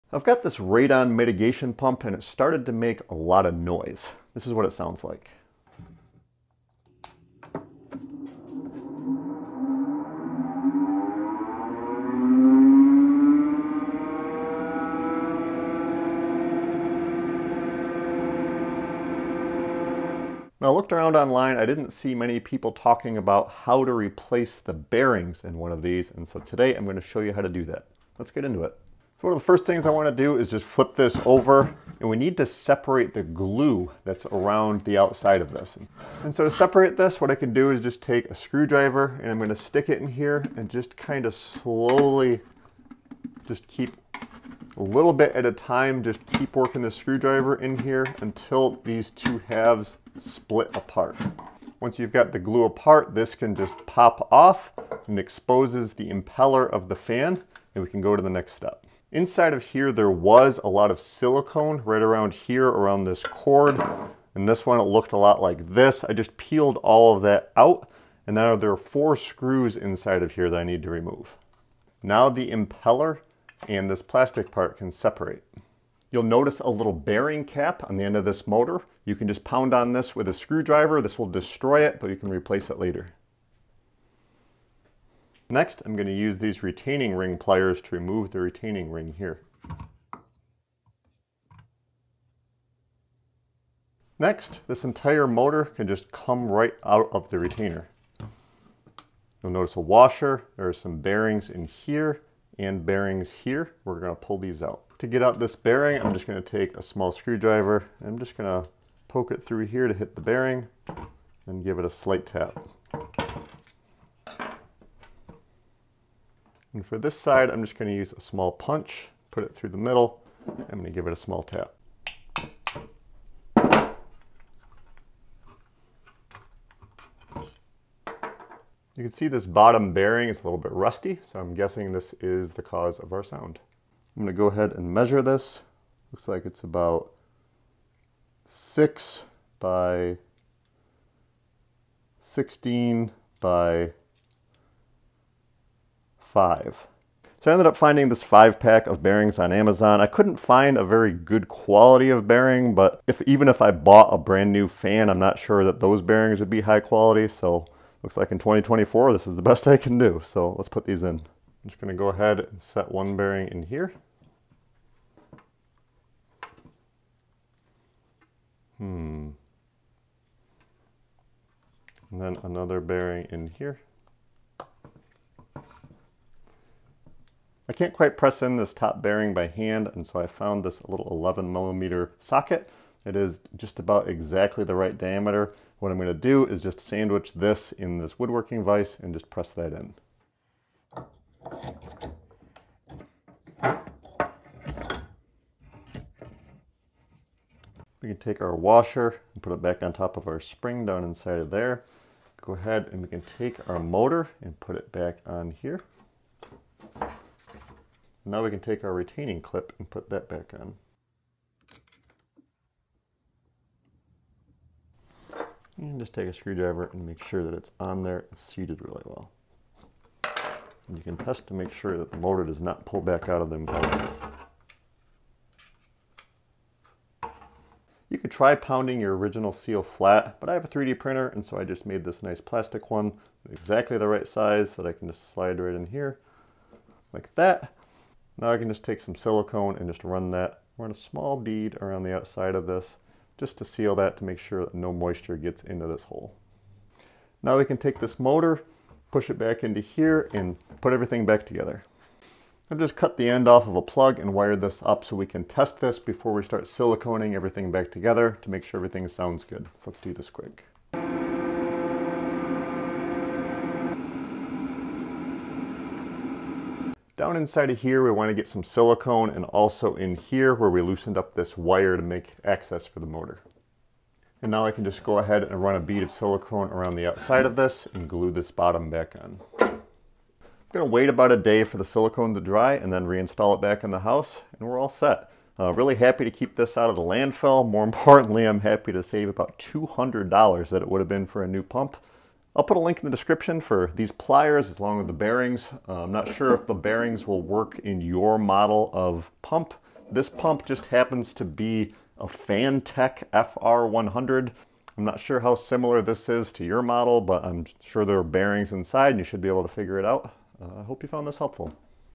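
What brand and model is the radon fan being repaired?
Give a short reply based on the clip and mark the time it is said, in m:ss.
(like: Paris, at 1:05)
Fantech FR100, at 5:02.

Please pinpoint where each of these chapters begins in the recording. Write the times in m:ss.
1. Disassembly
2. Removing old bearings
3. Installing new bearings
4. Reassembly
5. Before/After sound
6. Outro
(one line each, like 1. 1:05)
1. 0:28
2. 1:45
3. 2:41
4. 3:17
5. 4:20
6. 4:40.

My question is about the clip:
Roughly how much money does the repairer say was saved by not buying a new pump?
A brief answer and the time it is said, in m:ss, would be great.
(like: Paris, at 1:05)
$200, at 4:49.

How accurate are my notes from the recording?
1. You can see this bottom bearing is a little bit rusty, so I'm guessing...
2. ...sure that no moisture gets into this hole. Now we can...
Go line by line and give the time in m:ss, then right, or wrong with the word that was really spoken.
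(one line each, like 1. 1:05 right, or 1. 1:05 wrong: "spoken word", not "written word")
1. 2:08 right
2. 4:04 right.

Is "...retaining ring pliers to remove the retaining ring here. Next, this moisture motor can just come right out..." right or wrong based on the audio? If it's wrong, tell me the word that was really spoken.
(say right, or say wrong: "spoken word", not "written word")
wrong: "entire", not "moisture".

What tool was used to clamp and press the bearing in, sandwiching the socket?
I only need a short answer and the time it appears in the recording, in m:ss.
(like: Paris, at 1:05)
woodworking vise, at 3:08.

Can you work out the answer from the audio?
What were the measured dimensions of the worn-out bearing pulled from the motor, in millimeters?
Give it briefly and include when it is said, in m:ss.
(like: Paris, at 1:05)
6 x 16 x 5, at 2:18.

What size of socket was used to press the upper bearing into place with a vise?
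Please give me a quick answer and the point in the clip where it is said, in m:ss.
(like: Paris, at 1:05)
11 millimeter, at 3:01.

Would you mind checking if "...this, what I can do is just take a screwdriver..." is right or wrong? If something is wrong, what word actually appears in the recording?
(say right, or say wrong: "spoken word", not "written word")
right.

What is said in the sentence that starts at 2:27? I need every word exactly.
So I ended up finding this five pack of bearings on Amazon.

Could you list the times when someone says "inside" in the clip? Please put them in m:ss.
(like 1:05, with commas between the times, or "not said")
0:59, 1:09, 3:21, 4:27, 5:08.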